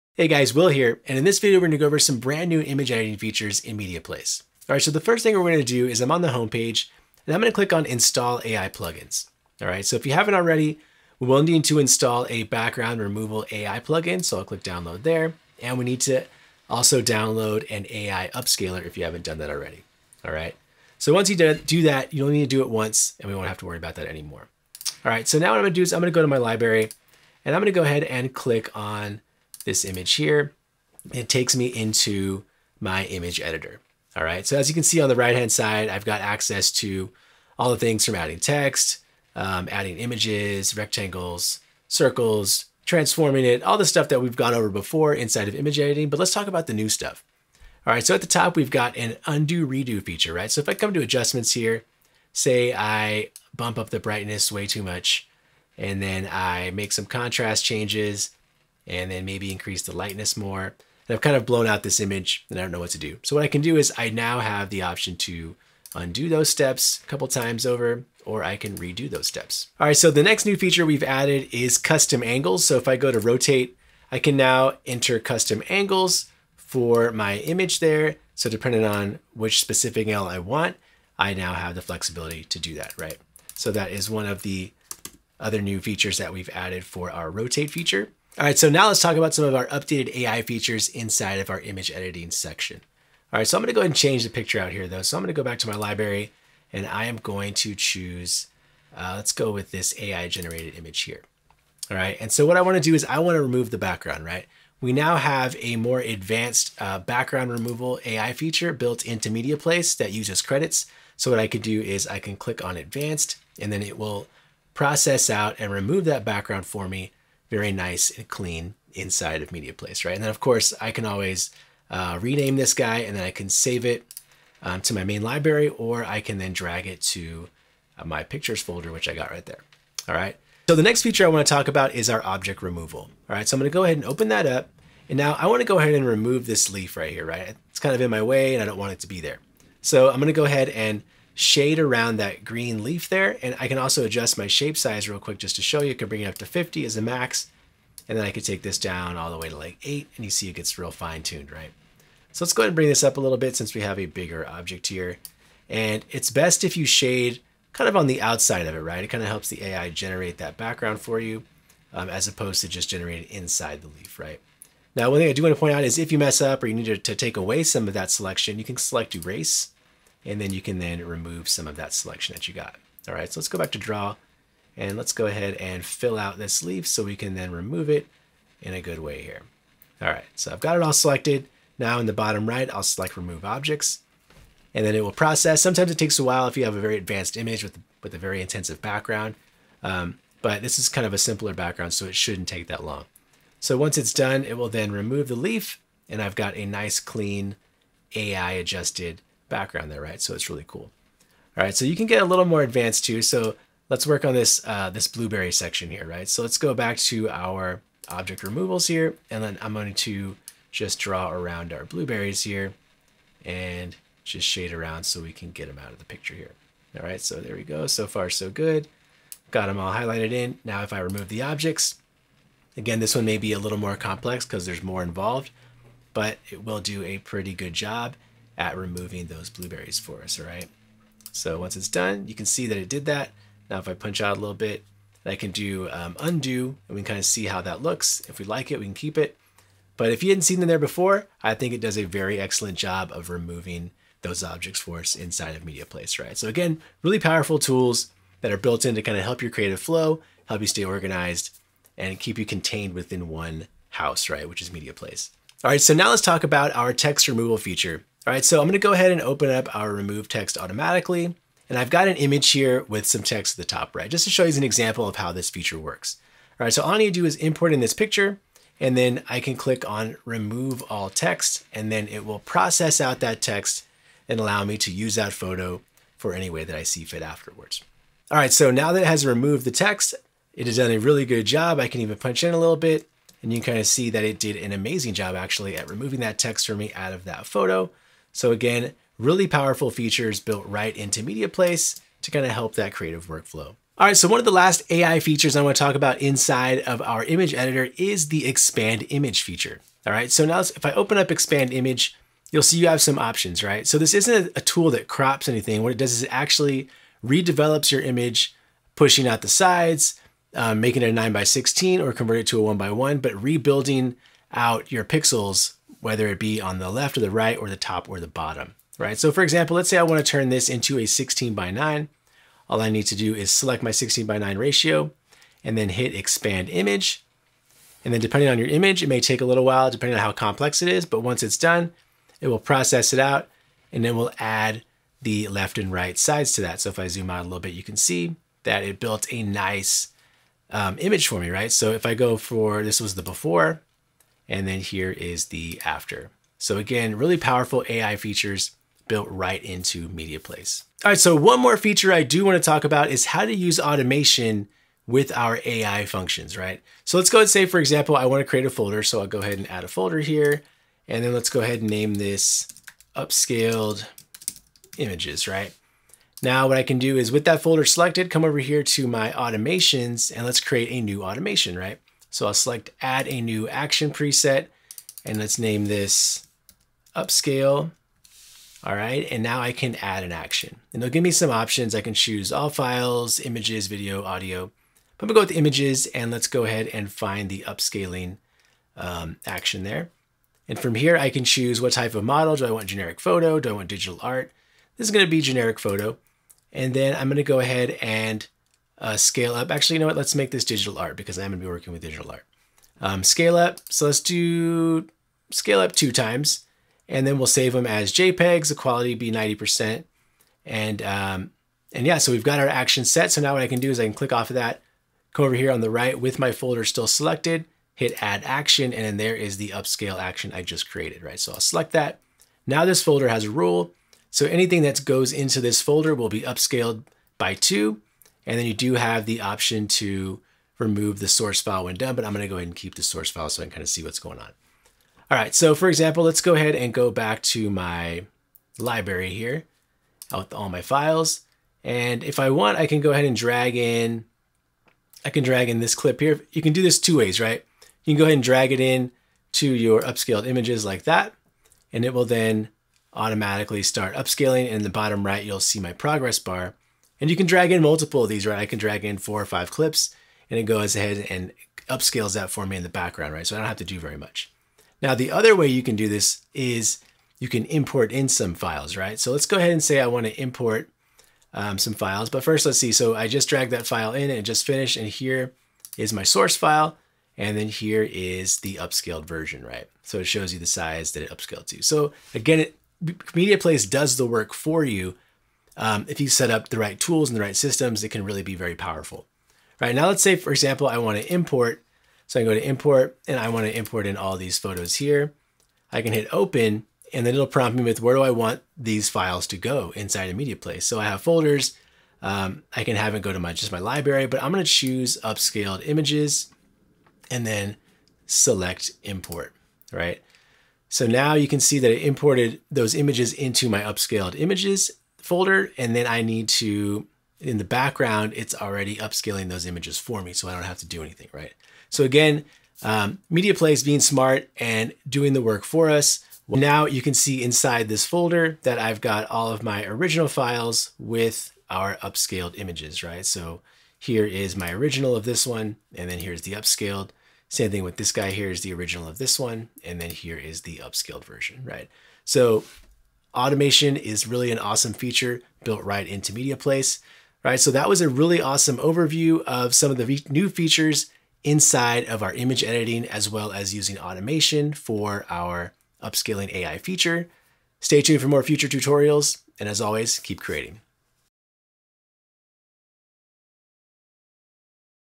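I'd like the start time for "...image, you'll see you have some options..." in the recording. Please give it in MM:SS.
05:01.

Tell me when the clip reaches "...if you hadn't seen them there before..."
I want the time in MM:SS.
04:00.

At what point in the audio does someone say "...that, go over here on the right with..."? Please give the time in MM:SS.
06:54.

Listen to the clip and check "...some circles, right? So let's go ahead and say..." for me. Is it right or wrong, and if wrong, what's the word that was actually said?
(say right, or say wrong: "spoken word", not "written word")
wrong: "files", not "circles".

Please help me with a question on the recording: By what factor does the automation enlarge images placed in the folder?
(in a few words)
2 times.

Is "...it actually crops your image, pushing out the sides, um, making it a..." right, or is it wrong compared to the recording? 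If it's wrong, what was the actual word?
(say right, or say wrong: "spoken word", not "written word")
wrong: "redevelops", not "crops".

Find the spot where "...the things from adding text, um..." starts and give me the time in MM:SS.
00:37.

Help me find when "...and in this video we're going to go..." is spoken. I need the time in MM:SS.
00:01.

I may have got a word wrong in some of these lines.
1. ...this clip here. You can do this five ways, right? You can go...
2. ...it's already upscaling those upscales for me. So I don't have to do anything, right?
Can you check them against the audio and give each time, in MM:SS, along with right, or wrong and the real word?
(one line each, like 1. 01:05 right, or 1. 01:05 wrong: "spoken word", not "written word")
1. 07:25 wrong: "two", not "five"
2. 08:38 wrong: "images", not "upscales".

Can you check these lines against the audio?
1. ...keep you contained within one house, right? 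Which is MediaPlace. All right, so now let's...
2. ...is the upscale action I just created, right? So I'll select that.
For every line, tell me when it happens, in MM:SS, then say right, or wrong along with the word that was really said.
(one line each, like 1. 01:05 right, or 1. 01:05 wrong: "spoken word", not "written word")
1. 04:12 right
2. 06:59 right.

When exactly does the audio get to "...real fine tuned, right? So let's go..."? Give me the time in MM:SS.
02:30.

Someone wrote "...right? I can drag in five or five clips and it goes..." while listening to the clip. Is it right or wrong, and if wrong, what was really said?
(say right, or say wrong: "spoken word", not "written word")
wrong: "four", not "five".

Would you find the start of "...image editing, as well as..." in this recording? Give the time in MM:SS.
09:12.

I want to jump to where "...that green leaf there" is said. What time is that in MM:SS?
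02:22.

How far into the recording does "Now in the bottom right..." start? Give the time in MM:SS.
03:01.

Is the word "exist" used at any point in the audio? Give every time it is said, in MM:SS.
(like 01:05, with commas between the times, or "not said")
not said.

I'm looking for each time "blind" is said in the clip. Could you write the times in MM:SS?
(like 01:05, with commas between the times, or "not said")
not said.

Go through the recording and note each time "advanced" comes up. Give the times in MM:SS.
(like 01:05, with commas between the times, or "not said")
01:45, 01:52, 03:06, 03:22.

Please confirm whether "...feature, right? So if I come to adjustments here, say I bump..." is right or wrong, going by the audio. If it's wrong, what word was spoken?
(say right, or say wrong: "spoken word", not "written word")
right.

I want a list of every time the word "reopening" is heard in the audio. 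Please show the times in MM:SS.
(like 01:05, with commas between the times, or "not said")
not said.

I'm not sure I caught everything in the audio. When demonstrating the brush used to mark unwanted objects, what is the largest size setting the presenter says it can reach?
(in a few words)
50.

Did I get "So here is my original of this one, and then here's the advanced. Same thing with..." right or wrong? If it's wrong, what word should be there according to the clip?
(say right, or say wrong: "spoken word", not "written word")
wrong: "upscaled", not "advanced".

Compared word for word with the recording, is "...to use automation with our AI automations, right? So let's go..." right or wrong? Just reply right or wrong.
wrong.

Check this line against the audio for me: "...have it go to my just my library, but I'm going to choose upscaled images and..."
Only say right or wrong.
right.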